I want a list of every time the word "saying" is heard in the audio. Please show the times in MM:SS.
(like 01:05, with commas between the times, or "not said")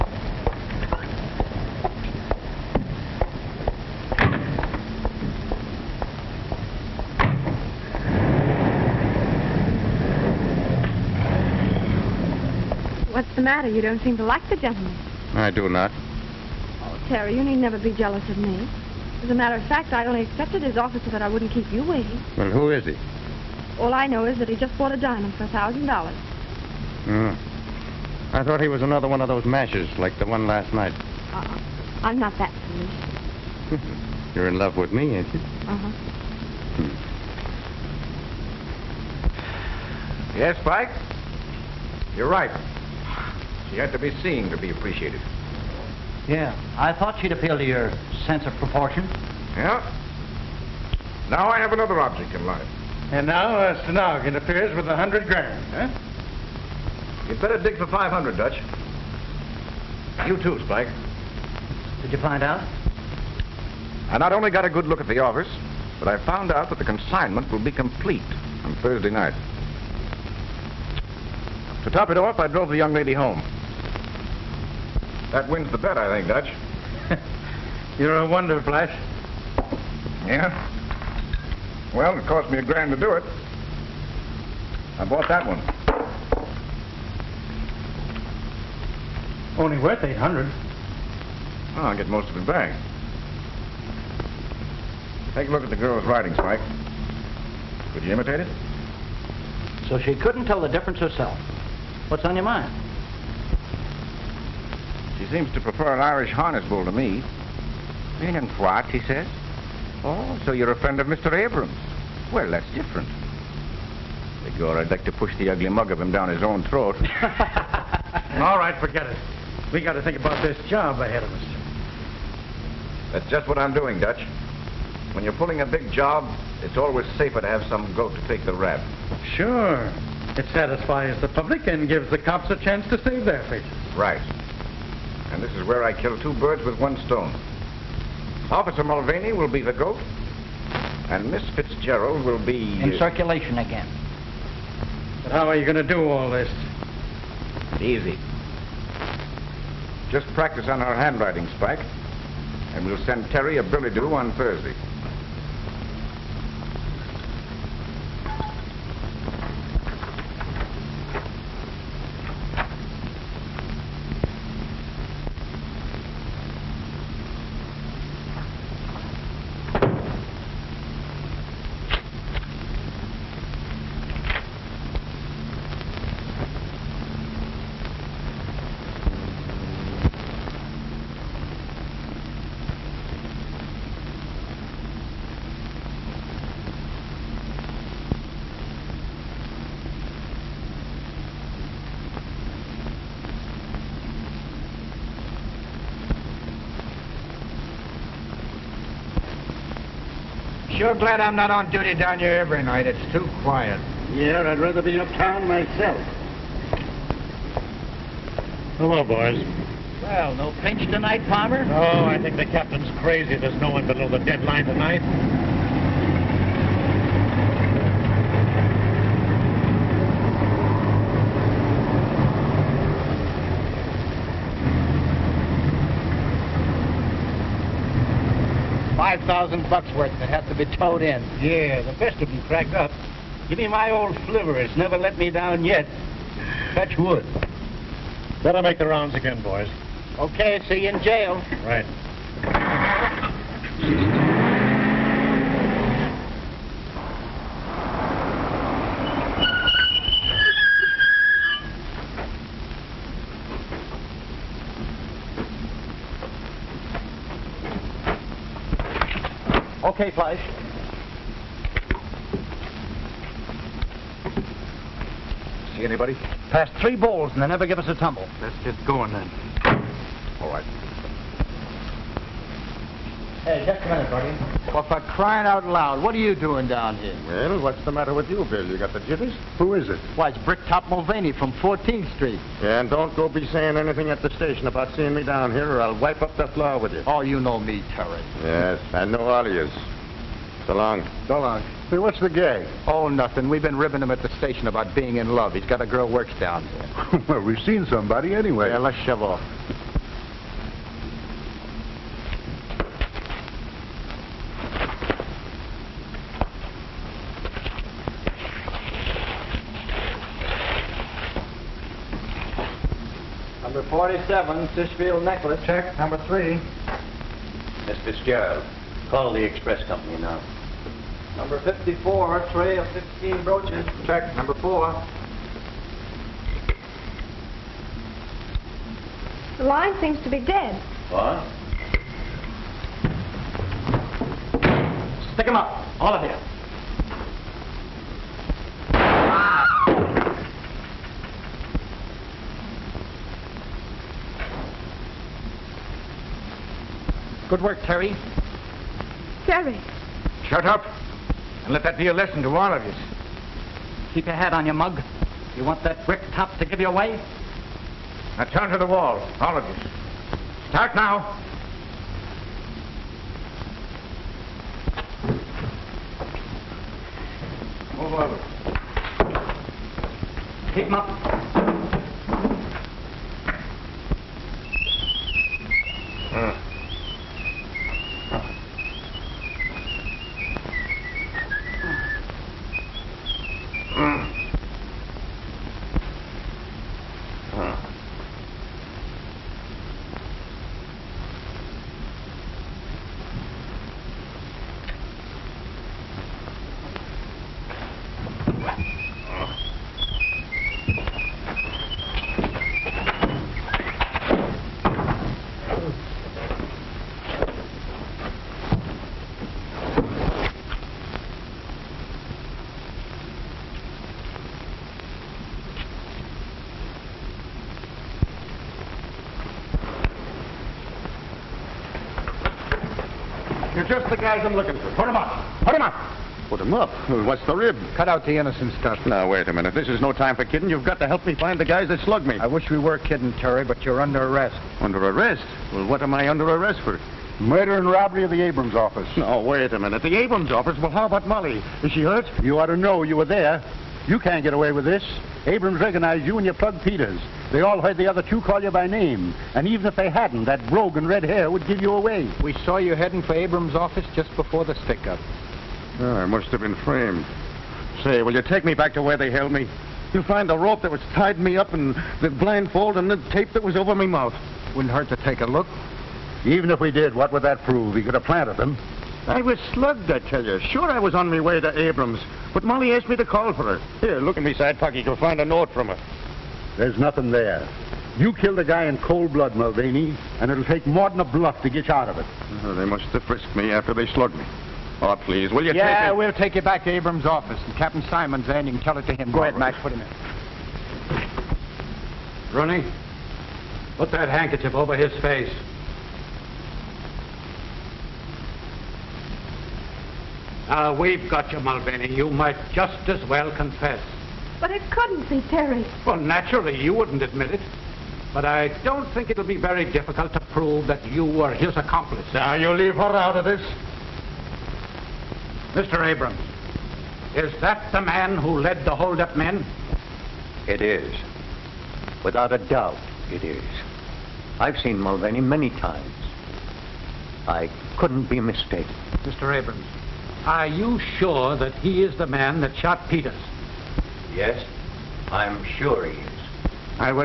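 04:43.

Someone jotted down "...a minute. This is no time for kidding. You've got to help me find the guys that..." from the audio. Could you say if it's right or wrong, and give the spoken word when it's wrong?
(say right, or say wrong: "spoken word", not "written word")
right.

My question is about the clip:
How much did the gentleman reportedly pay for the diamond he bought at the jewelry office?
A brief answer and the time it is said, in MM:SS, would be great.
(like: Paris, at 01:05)
$1,000, at 00:25.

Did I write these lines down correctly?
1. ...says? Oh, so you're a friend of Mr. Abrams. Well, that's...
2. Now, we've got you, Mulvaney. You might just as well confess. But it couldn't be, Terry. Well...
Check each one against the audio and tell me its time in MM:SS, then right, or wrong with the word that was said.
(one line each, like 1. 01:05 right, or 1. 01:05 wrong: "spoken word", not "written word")
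1. 01:49 right
2. 08:20 right.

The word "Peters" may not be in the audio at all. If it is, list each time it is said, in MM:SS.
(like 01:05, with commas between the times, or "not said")
07:26, 08:53.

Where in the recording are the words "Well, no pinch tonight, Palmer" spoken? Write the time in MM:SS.
03:30.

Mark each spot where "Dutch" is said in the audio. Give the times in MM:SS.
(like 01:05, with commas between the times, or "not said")
00:58, 01:16, 02:04.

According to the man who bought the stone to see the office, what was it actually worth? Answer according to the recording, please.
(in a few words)
800.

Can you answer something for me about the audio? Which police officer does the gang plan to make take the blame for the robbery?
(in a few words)
Officer Mulvaney.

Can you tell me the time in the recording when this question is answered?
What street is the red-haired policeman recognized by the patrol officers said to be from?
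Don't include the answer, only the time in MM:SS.
04:41.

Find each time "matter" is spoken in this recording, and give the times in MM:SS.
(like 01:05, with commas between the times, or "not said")
00:13, 00:19, 04:37.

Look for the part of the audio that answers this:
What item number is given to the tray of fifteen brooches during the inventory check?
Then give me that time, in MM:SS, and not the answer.
05:21.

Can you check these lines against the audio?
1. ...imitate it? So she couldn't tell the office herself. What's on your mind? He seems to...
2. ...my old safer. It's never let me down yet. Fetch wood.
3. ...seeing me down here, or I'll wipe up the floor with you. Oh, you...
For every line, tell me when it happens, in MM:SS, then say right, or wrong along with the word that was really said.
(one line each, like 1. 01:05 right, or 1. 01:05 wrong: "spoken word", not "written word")
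1. 01:38 wrong: "difference", not "office"
2. 03:53 wrong: "flivver", not "safer"
3. 04:44 right.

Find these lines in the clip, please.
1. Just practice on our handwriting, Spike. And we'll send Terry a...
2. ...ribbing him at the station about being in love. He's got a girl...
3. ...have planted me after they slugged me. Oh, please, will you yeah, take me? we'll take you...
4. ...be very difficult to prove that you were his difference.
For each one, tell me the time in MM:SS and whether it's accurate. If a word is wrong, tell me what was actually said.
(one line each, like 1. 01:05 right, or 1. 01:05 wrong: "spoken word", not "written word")
1. 02:30 right
2. 04:53 right
3. 08:03 wrong: "frisked", not "planted"
4. 08:29 wrong: "accomplice", not "difference".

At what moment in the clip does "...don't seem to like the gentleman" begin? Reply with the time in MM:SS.
00:13.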